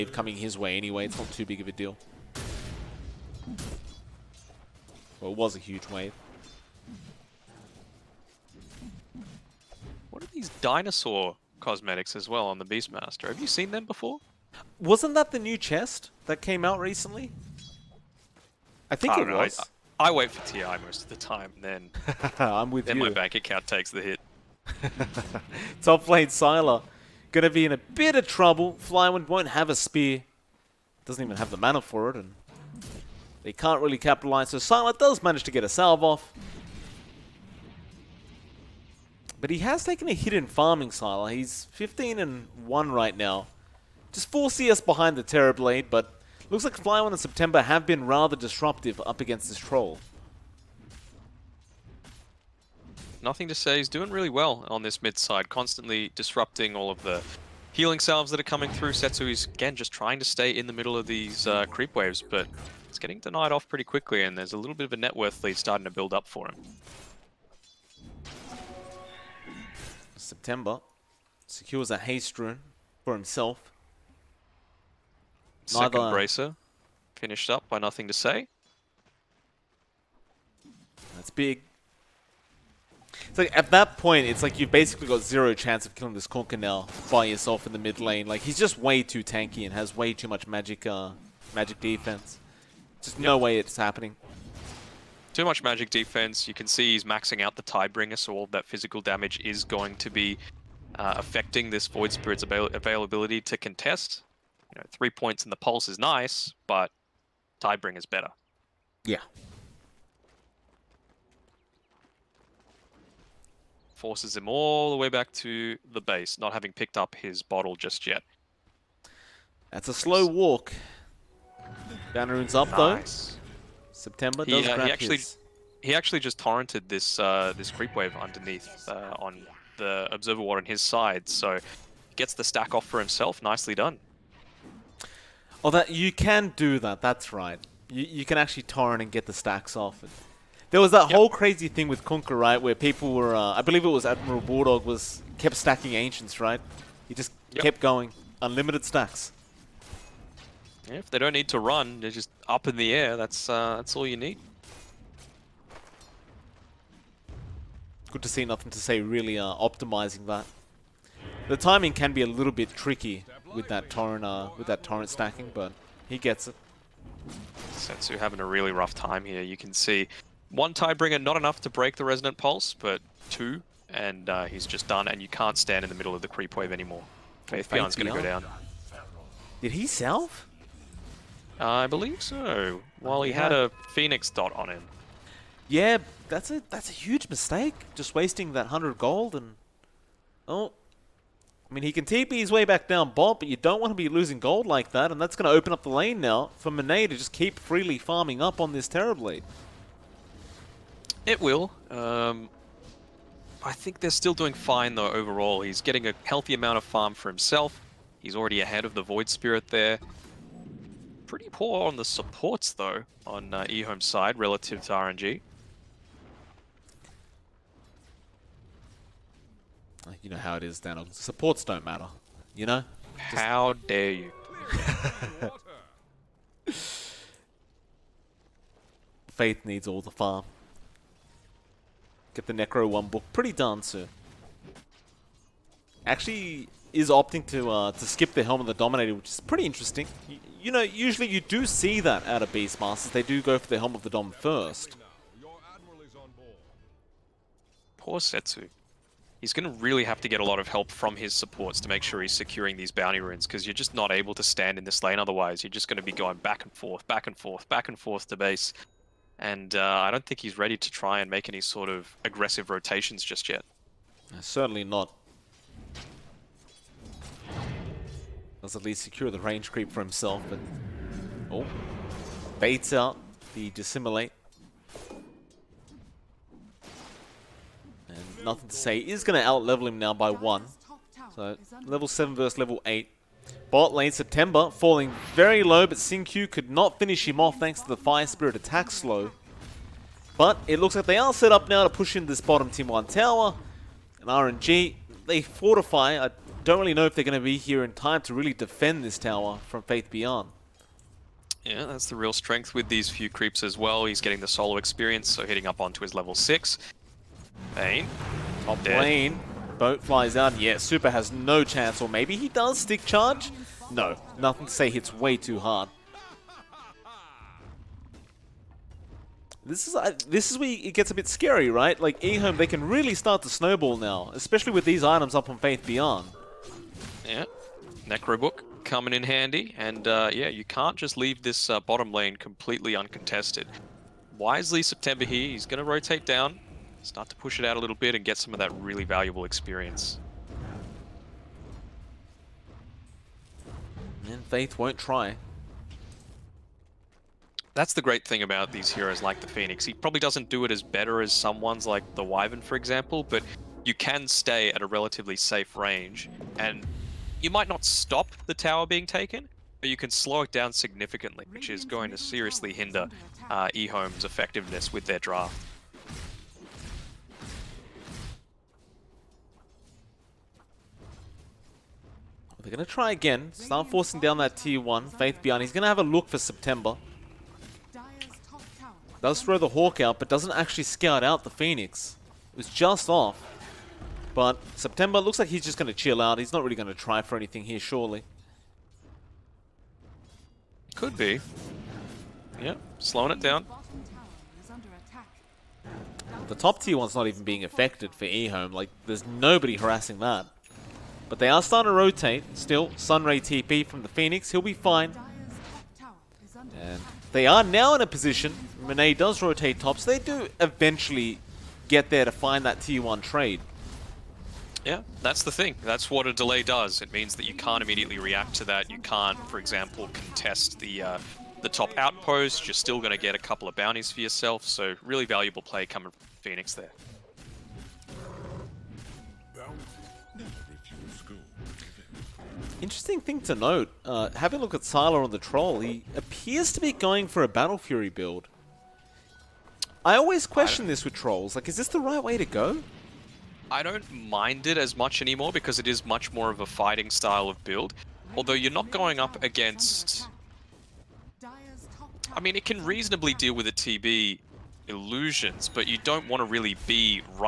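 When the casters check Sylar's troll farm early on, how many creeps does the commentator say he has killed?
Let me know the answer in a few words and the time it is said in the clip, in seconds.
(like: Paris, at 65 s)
15, at 41 s.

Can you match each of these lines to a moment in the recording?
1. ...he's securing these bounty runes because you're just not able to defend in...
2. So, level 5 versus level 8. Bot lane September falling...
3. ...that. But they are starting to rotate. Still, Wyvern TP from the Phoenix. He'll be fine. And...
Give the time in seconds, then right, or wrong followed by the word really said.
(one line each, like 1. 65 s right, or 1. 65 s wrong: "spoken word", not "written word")
1. 252 s wrong: "stand", not "defend"
2. 281 s wrong: "7", not "5"
3. 400 s wrong: "Sunray", not "Wyvern".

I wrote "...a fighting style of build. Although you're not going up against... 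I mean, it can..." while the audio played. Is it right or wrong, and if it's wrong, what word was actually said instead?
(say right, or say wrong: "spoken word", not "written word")
right.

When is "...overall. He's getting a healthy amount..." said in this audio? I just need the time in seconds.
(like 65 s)
205 s.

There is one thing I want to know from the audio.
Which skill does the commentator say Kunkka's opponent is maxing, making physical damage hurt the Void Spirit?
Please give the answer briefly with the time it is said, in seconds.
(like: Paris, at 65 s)
Tidebringer, at 97 s.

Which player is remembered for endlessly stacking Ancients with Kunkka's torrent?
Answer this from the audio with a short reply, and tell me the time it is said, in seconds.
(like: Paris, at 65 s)
Admiral Bulldog, at 144 s.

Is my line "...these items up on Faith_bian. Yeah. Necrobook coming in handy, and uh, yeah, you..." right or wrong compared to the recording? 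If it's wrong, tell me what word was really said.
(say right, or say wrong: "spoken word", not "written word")
right.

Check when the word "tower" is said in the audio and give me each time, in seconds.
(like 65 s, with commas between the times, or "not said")
293 s, 299 s, 358 s.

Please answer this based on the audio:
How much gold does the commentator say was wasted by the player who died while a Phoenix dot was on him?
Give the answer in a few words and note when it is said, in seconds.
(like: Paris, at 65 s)
100, at 188 s.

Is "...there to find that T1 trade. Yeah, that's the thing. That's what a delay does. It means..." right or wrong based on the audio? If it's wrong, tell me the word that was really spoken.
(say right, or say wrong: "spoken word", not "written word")
right.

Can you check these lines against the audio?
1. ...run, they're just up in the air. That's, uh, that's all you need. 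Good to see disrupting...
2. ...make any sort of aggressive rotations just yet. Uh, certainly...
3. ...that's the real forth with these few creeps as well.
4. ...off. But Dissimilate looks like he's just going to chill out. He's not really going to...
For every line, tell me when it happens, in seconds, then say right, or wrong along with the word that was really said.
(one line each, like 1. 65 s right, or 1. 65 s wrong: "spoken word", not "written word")
1. 151 s wrong: "nothing", not "disrupting"
2. 261 s right
3. 301 s wrong: "strength", not "forth"
4. 383 s wrong: "September", not "Dissimilate".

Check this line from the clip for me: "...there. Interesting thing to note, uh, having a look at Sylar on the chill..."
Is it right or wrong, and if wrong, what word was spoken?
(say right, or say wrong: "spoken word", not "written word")
wrong: "troll", not "chill".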